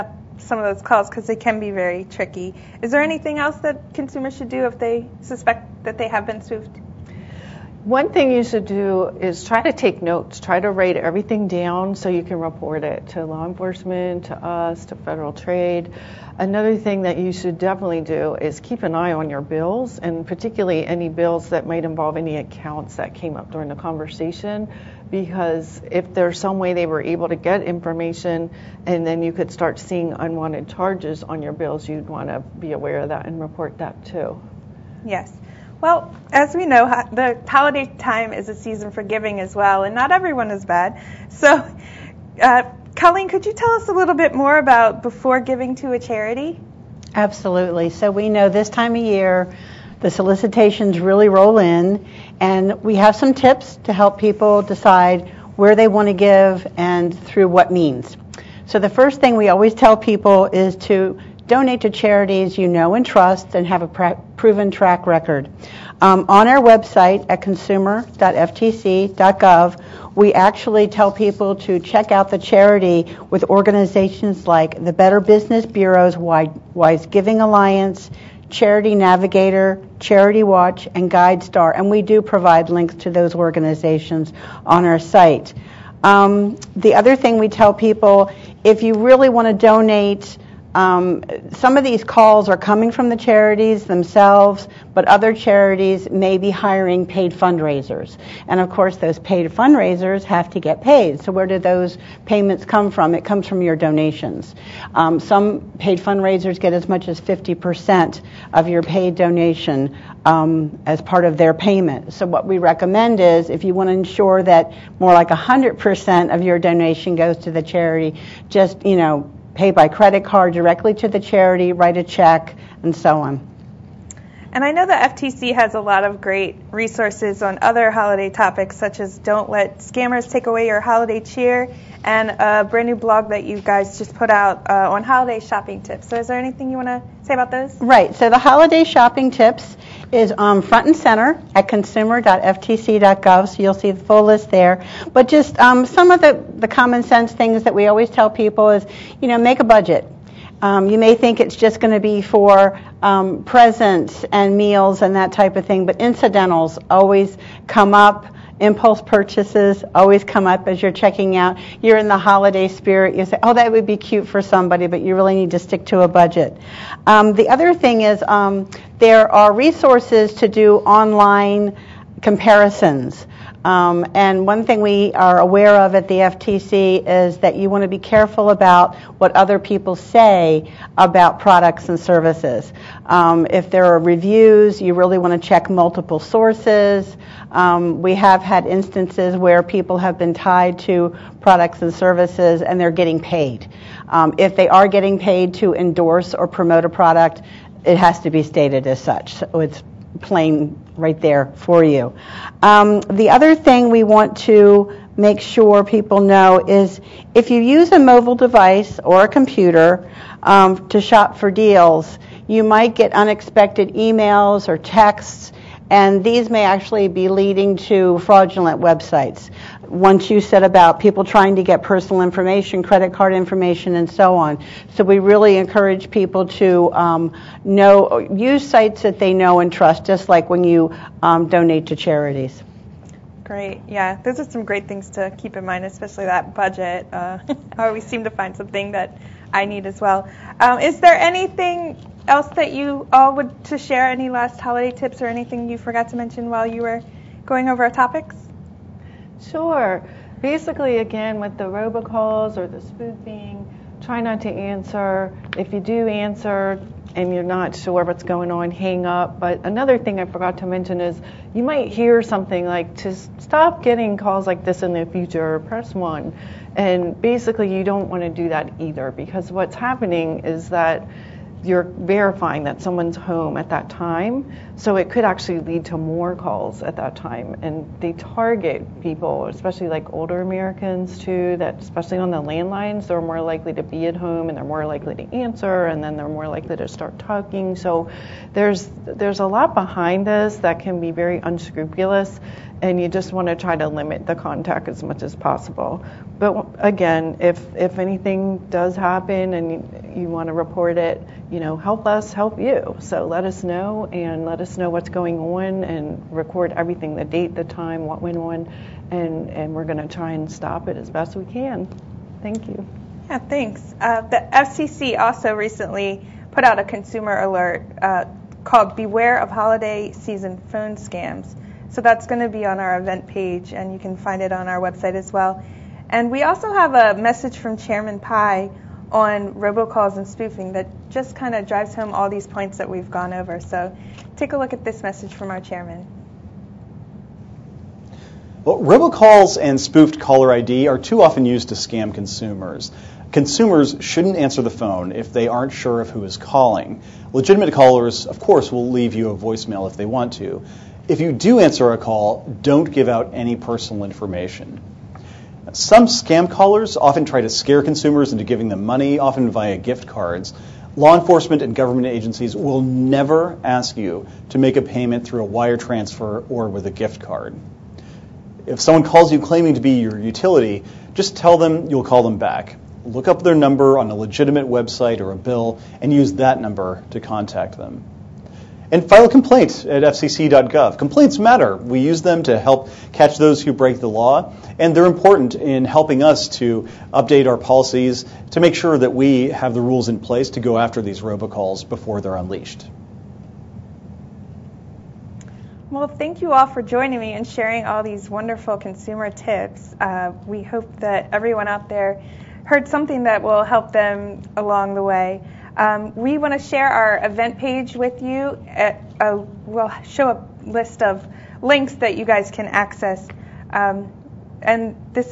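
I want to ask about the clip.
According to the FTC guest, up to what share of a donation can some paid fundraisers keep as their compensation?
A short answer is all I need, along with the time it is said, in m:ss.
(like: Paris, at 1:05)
50%, at 1:47.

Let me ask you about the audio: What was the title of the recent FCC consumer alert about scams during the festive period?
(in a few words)
Beware of Holiday Season Phone Scams.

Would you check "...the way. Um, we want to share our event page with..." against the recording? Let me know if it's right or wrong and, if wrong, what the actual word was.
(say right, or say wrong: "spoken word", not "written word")
right.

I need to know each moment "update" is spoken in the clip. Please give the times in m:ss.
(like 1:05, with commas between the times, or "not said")
6:27.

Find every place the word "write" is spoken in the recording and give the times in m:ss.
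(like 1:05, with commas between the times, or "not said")
0:10, 2:01.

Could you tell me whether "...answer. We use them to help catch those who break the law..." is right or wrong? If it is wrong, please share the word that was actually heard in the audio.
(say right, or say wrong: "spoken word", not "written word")
wrong: "matter", not "answer".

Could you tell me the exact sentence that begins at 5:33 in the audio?
So take a look at this message from our chairman.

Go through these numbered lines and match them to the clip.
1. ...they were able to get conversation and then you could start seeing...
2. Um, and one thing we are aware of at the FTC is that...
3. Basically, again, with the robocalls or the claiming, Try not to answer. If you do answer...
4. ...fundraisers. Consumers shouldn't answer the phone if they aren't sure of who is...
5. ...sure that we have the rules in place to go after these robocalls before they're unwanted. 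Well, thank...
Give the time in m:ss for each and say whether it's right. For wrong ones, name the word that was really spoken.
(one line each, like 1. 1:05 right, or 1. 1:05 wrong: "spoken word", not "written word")
1. 0:26 wrong: "information", not "conversation"
2. 2:53 right
3. 4:10 wrong: "spoofing", not "claiming"
4. 5:42 wrong: "consumers", not "fundraisers"
5. 6:28 wrong: "unleashed", not "unwanted".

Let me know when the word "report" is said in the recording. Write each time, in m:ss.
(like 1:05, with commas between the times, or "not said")
0:12, 0:33, 5:00.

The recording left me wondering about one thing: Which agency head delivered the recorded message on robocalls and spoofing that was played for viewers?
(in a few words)
Chairman Pai.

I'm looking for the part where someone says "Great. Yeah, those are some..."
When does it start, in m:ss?
3:53.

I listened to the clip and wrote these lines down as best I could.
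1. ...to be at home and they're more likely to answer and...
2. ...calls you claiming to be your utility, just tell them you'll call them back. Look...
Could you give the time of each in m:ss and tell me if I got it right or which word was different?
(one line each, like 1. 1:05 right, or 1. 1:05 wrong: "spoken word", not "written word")
1. 4:43 right
2. 6:09 right.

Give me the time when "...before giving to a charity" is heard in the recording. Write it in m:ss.
0:45.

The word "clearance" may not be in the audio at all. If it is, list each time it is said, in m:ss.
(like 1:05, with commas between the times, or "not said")
not said.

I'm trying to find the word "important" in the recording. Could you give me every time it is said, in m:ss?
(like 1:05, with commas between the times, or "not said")
6:25.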